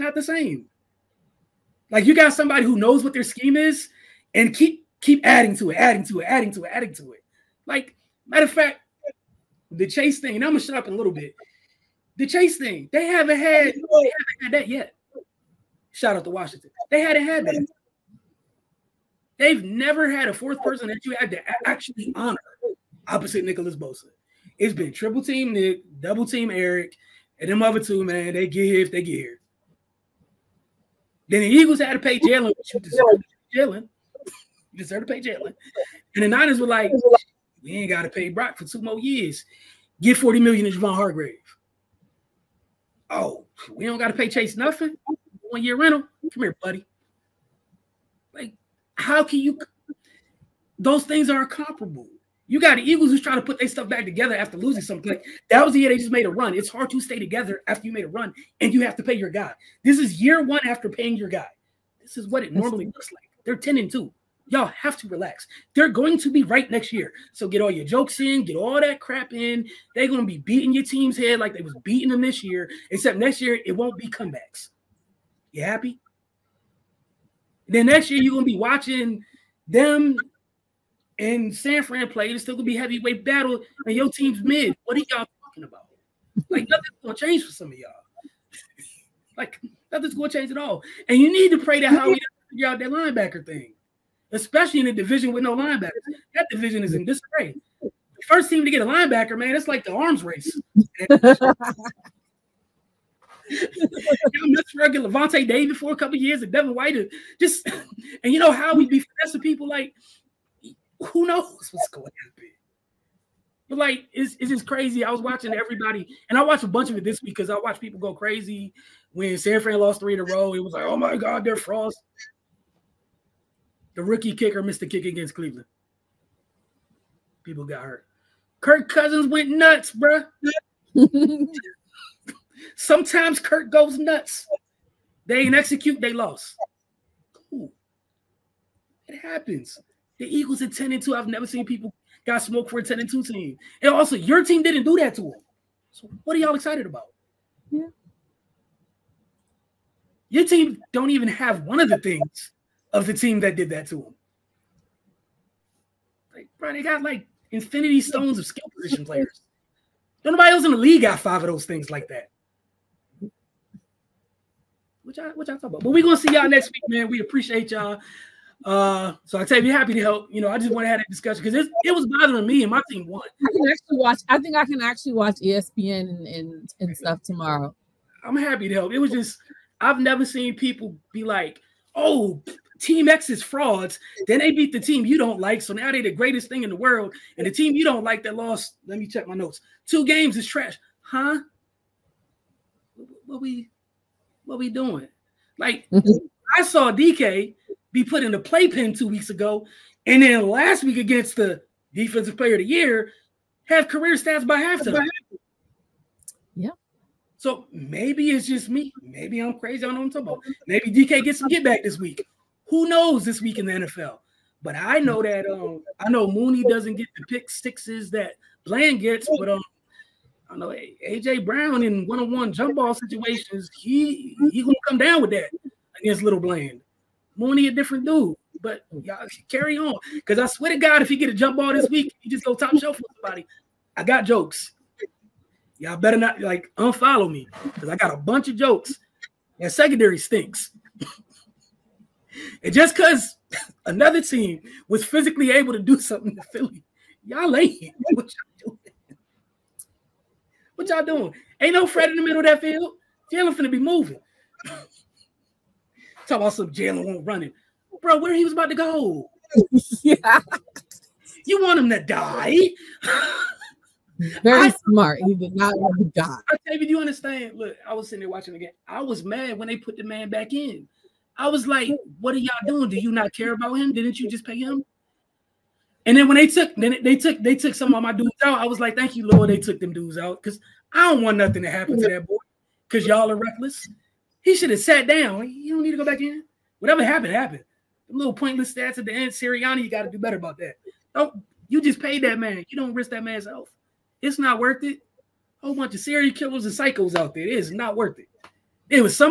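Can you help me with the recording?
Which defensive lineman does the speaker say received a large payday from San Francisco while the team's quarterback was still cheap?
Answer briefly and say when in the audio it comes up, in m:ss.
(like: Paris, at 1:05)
Javon Hargrave, at 0:40.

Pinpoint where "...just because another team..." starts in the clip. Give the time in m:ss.
4:02.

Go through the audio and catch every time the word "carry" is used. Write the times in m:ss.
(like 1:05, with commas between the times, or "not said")
3:49.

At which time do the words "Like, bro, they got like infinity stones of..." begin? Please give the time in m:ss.
2:36.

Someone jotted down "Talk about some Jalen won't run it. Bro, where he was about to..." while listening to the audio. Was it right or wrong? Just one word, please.
right.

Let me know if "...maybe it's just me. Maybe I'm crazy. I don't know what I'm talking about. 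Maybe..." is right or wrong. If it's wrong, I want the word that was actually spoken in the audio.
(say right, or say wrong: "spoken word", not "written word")
right.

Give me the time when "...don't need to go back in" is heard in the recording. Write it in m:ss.
4:45.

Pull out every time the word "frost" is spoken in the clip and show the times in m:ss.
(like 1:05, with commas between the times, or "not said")
2:01.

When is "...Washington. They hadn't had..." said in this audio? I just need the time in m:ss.
0:16.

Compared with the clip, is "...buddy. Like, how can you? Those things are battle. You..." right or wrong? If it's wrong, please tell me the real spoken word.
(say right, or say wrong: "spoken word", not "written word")
wrong: "comparable", not "battle".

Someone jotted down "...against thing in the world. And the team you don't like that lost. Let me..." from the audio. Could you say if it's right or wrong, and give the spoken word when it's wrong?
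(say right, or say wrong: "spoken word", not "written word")
wrong: "greatest", not "against".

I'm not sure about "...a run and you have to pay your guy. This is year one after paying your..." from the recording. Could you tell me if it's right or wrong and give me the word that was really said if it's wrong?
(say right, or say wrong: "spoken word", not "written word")
right.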